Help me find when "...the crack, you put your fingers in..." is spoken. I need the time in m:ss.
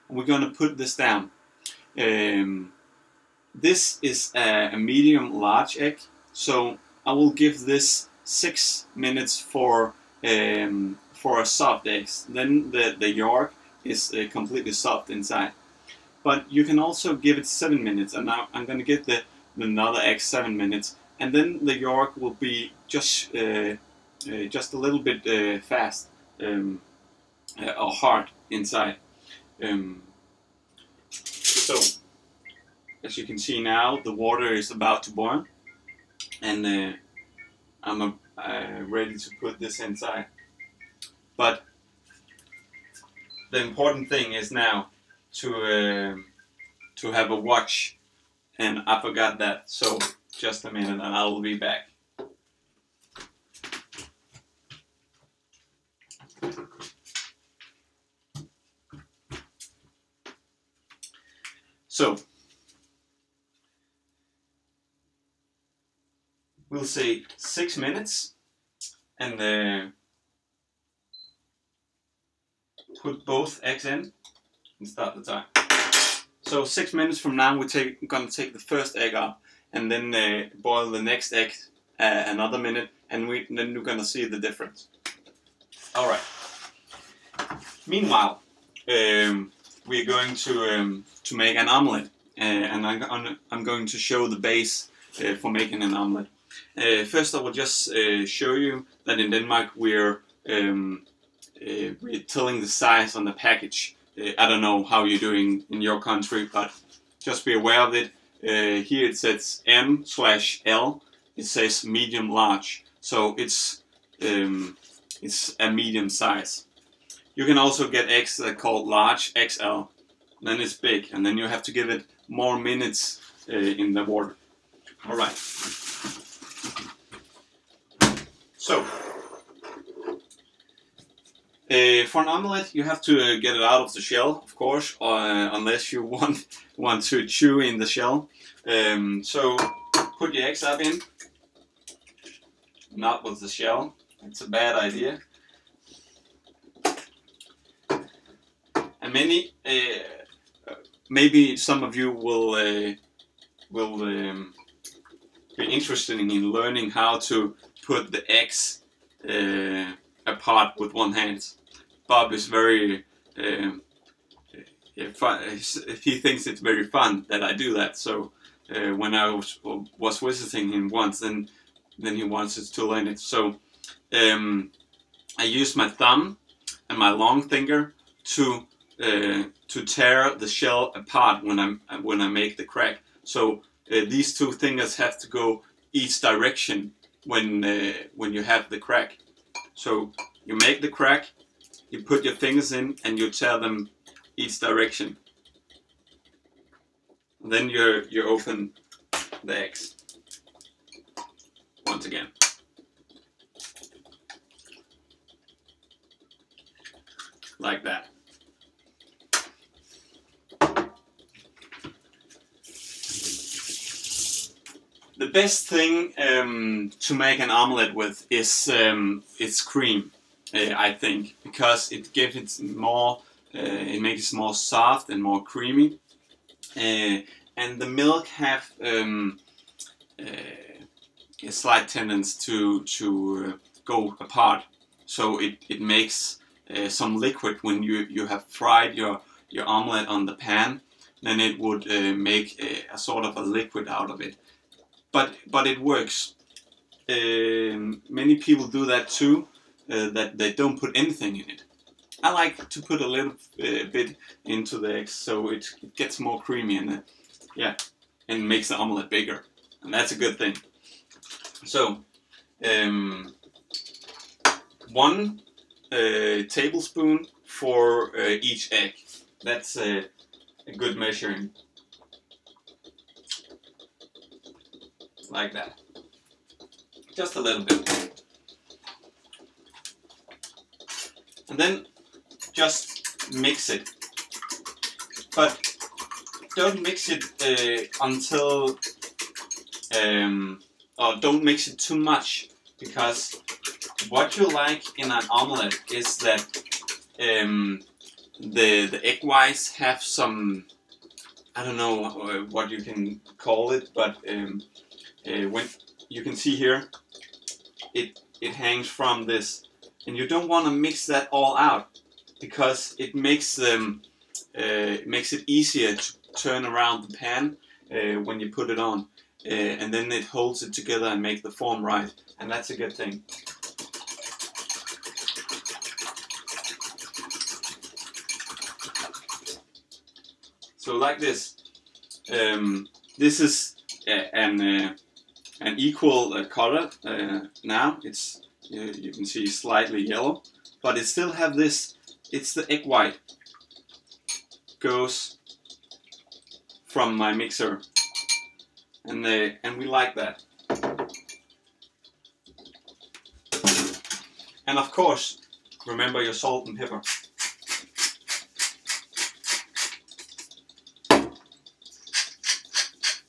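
3:10.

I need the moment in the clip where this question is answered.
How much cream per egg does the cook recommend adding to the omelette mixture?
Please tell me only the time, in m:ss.
4:24.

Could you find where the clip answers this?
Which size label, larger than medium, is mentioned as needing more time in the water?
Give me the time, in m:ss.
1:59.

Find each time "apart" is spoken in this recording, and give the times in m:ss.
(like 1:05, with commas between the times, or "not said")
2:40, 3:01, 3:54.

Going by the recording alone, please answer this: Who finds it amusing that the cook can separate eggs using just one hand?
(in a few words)
Bob.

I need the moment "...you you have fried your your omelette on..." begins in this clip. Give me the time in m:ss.
3:57.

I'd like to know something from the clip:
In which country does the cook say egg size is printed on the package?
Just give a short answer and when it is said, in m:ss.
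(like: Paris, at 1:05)
Denmark, at 1:39.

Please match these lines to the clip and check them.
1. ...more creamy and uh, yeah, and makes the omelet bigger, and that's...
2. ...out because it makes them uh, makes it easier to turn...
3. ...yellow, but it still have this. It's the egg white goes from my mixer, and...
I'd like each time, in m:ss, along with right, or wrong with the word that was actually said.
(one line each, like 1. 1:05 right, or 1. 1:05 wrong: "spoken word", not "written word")
1. 4:16 right
2. 5:11 right
3. 5:40 right.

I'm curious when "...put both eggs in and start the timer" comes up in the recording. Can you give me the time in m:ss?
1:13.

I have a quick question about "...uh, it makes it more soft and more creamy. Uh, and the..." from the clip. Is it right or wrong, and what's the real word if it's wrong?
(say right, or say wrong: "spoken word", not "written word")
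right.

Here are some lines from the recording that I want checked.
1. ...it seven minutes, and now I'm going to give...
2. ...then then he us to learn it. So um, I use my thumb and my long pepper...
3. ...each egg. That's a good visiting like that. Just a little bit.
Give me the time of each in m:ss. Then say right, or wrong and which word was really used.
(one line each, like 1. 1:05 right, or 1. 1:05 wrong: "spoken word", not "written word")
1. 0:17 right
2. 2:51 wrong: "finger", not "pepper"
3. 4:28 wrong: "measuring", not "visiting".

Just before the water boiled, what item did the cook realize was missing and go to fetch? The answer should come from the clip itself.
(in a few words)
a watch.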